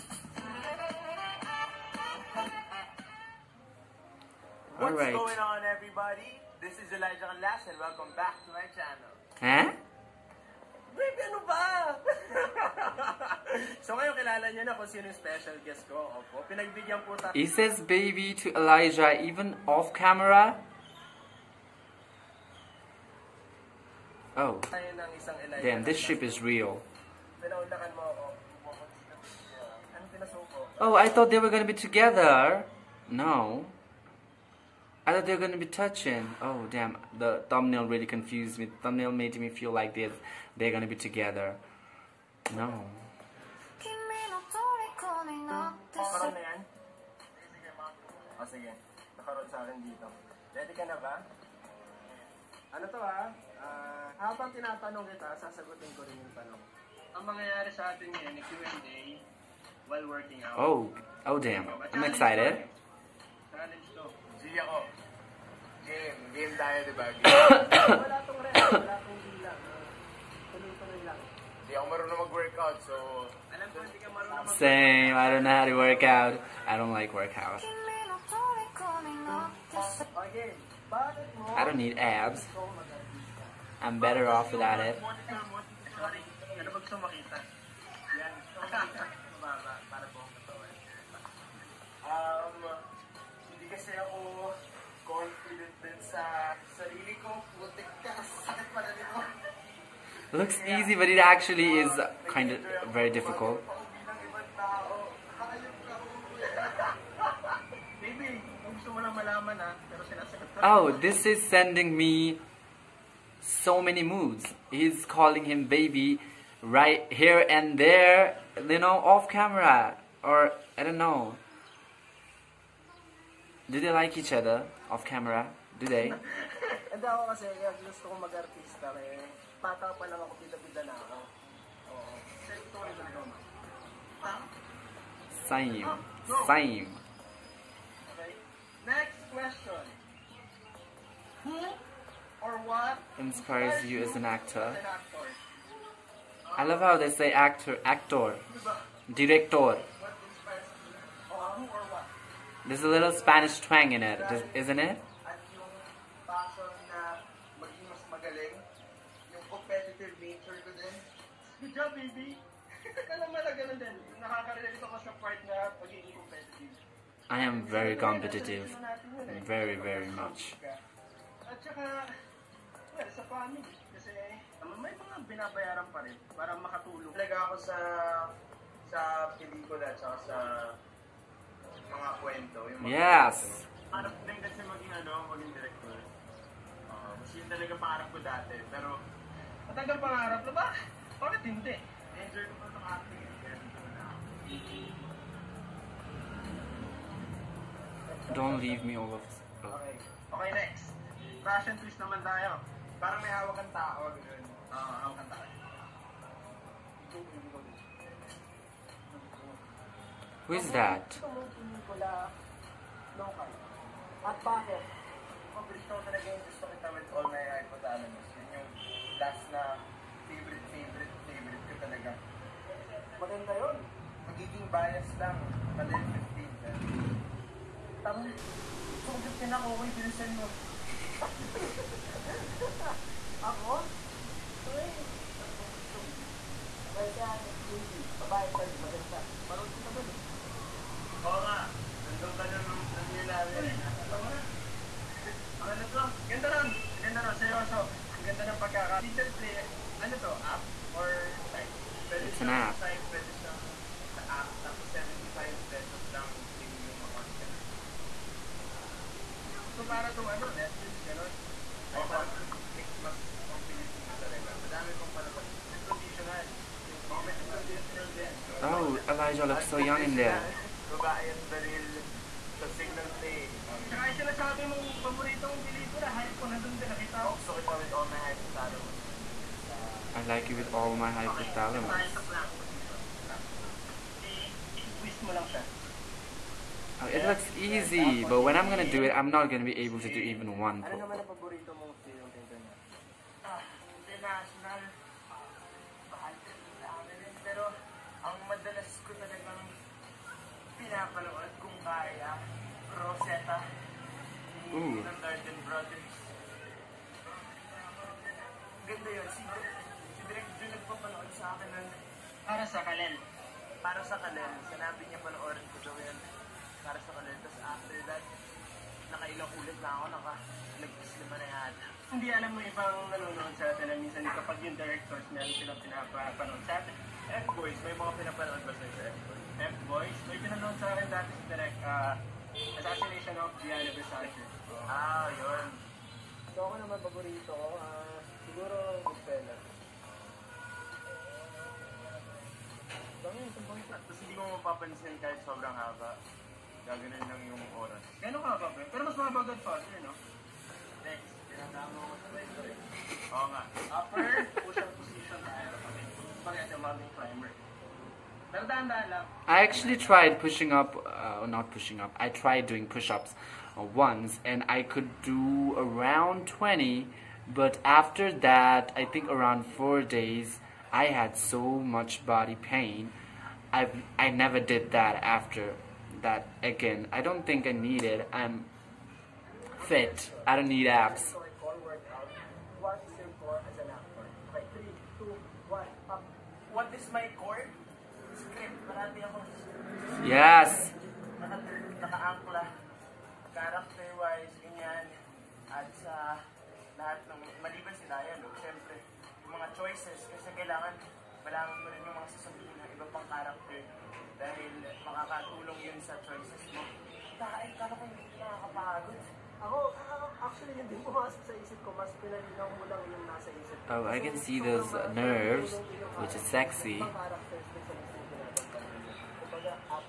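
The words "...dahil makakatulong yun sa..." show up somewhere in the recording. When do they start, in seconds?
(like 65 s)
404 s.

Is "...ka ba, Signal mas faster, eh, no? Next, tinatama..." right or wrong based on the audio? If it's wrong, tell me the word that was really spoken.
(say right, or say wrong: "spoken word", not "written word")
wrong: "Pero", not "Signal".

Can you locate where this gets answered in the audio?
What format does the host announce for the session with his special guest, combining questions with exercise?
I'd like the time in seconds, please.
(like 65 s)
58 s.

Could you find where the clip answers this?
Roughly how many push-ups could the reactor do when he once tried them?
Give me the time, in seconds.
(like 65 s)
366 s.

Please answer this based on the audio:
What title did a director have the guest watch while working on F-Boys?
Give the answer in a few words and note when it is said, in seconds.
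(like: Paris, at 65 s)
Assassination of Gianni Versace, at 332 s.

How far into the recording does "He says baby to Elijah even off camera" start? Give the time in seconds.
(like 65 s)
17 s.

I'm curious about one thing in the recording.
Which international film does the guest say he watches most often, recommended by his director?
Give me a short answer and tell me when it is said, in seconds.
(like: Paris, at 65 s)
Rosetta, at 302 s.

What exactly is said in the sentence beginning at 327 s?
F-Boys, may mga pinapanood ba sa F-Boys?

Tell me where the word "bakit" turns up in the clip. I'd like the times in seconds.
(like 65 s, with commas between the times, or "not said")
191 s, 214 s.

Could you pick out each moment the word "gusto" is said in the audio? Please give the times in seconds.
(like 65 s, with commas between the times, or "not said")
108 s, 126 s, 216 s.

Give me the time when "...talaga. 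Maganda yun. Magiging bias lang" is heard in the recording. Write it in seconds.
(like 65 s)
221 s.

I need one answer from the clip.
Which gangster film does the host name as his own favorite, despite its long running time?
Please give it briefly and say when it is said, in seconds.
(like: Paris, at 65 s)
Goodfellas, at 339 s.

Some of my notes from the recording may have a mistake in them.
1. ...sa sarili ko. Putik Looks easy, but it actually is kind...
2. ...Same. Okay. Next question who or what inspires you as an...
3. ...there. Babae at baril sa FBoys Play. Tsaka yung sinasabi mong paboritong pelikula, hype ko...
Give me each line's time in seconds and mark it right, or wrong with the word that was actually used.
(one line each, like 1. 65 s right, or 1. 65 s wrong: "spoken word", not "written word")
1. 96 s right
2. 136 s right
3. 270 s wrong: "Signal", not "FBoys".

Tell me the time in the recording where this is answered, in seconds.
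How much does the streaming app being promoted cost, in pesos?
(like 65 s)
254 s.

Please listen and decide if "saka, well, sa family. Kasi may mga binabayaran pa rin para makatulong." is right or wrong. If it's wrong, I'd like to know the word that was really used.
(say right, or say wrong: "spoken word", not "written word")
right.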